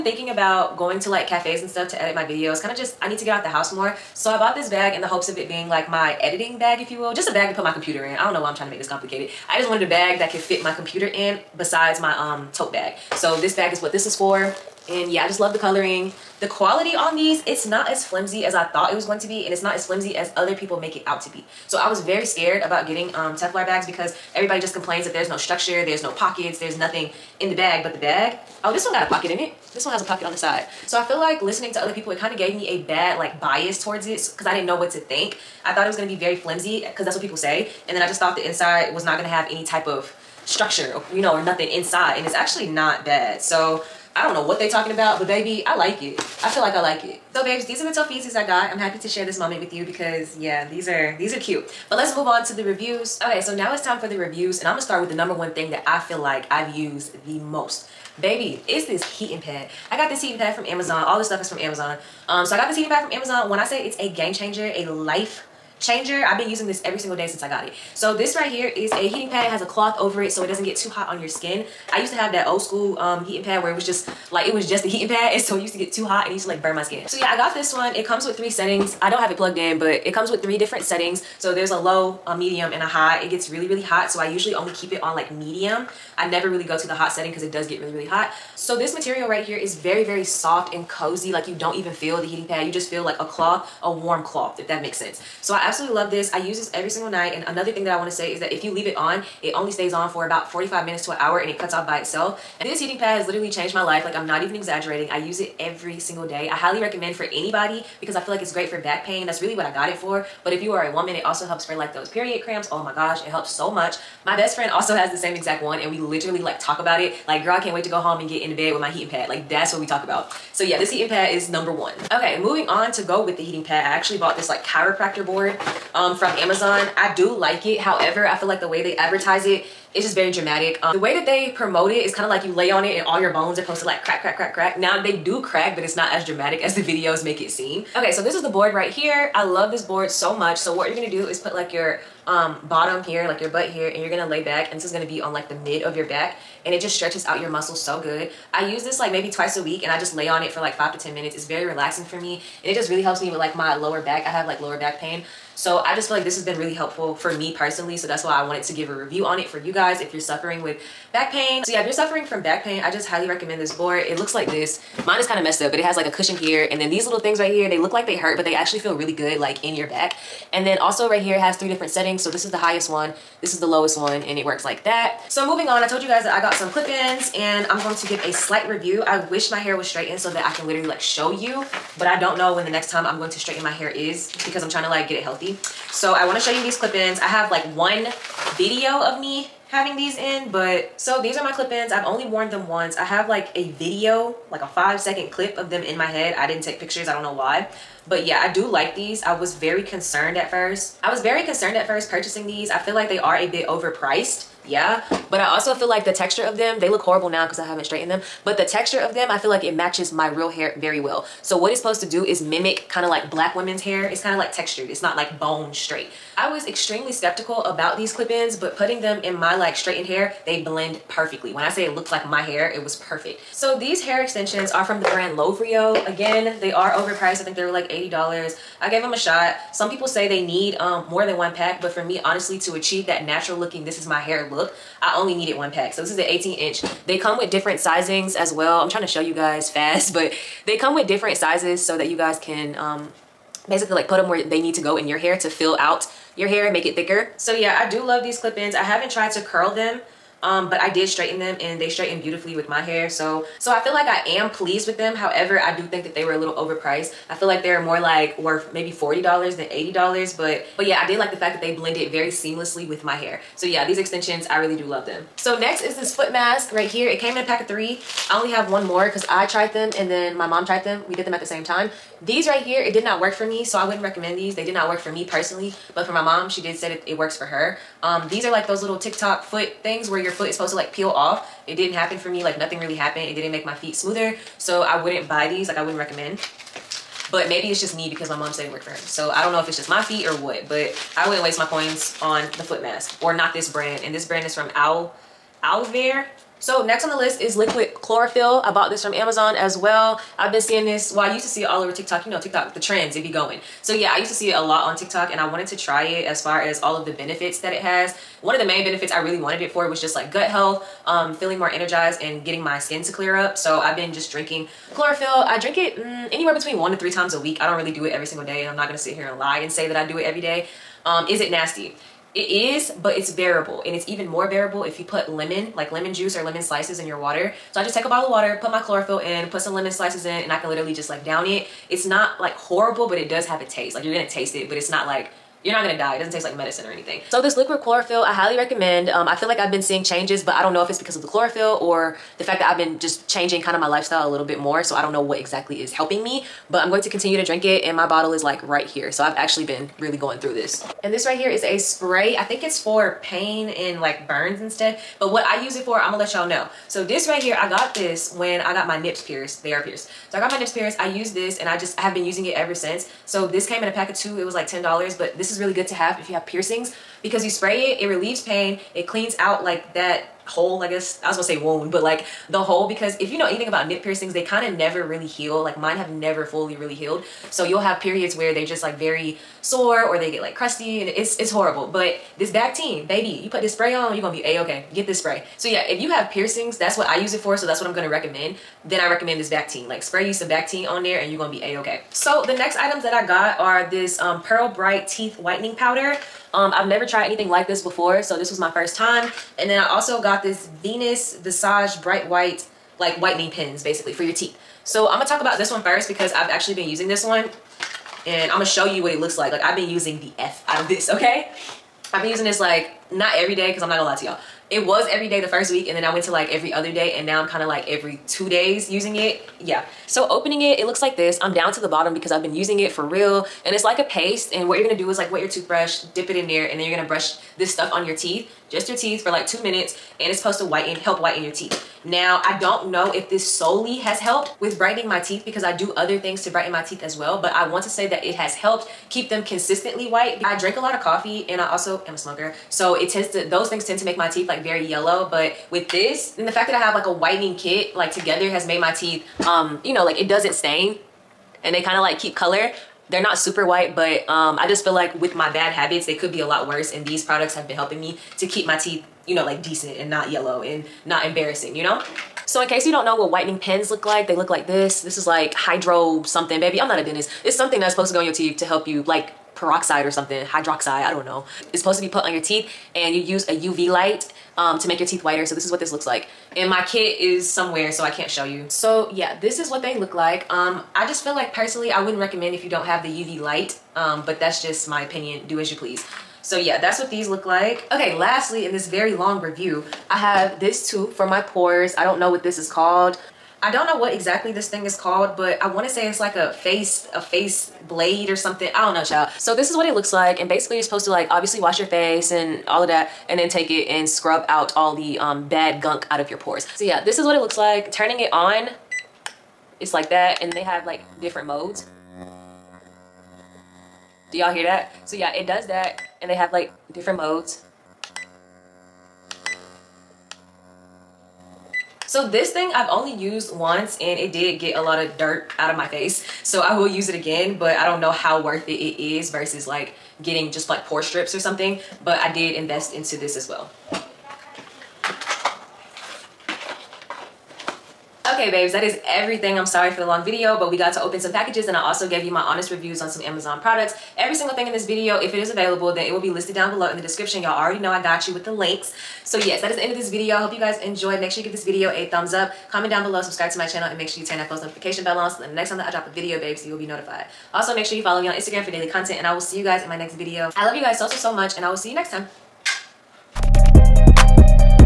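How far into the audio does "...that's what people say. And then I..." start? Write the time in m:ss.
0:37.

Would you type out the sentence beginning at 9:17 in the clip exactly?
Also, make sure you follow me on Instagram for daily content and I will see you guys in my next video.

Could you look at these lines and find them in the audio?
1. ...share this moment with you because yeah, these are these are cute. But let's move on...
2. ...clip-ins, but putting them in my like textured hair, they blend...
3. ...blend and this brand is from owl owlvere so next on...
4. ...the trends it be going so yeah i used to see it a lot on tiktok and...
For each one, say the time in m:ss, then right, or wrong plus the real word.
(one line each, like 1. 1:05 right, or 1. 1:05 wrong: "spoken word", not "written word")
1. 0:49 right
2. 3:38 wrong: "straightened", not "textured"
3. 4:53 wrong: "brand", not "blend"
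4. 5:02 right.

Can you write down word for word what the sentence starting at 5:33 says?
Like you're gonna taste it, but it's not like you're not gonna die.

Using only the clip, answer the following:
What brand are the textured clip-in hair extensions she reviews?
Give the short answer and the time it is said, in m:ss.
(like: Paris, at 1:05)
Lovrio, at 3:45.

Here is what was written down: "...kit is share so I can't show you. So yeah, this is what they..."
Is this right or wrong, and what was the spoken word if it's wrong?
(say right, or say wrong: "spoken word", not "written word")
wrong: "somewhere", not "share".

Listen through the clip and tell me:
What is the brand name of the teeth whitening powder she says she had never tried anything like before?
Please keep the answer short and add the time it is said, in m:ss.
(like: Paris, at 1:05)
Pearl Bright, at 6:34.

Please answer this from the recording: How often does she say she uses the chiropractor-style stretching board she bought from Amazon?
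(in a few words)
twice a week.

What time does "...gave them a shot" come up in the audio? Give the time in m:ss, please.
3:48.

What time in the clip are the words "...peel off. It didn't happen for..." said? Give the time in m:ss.
4:40.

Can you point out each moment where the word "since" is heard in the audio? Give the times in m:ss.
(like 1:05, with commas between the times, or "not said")
1:07, 6:02.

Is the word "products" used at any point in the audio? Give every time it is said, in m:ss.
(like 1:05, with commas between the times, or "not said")
7:37, 9:03.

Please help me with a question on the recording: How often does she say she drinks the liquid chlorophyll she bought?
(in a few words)
1 to 3 times a week.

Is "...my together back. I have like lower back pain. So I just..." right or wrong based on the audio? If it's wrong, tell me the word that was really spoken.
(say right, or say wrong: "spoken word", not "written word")
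wrong: "lower", not "together".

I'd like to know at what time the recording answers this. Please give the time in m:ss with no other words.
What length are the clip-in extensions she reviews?
3:56.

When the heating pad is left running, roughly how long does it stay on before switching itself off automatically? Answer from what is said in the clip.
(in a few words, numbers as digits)
45 minutes to an hour.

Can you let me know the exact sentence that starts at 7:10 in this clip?
And it's supposed to whiten, help whiten your teeth.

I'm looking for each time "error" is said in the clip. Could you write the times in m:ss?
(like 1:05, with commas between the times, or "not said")
not said.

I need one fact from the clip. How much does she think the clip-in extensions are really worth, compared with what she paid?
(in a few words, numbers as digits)
$40.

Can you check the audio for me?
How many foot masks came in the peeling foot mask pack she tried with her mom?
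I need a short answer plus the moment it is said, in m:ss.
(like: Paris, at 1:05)
3, at 4:27.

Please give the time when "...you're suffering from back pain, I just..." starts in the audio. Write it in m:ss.
2:41.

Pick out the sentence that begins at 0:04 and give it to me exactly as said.
So I bought this bag in the hopes of it being like my editing bag, if you will.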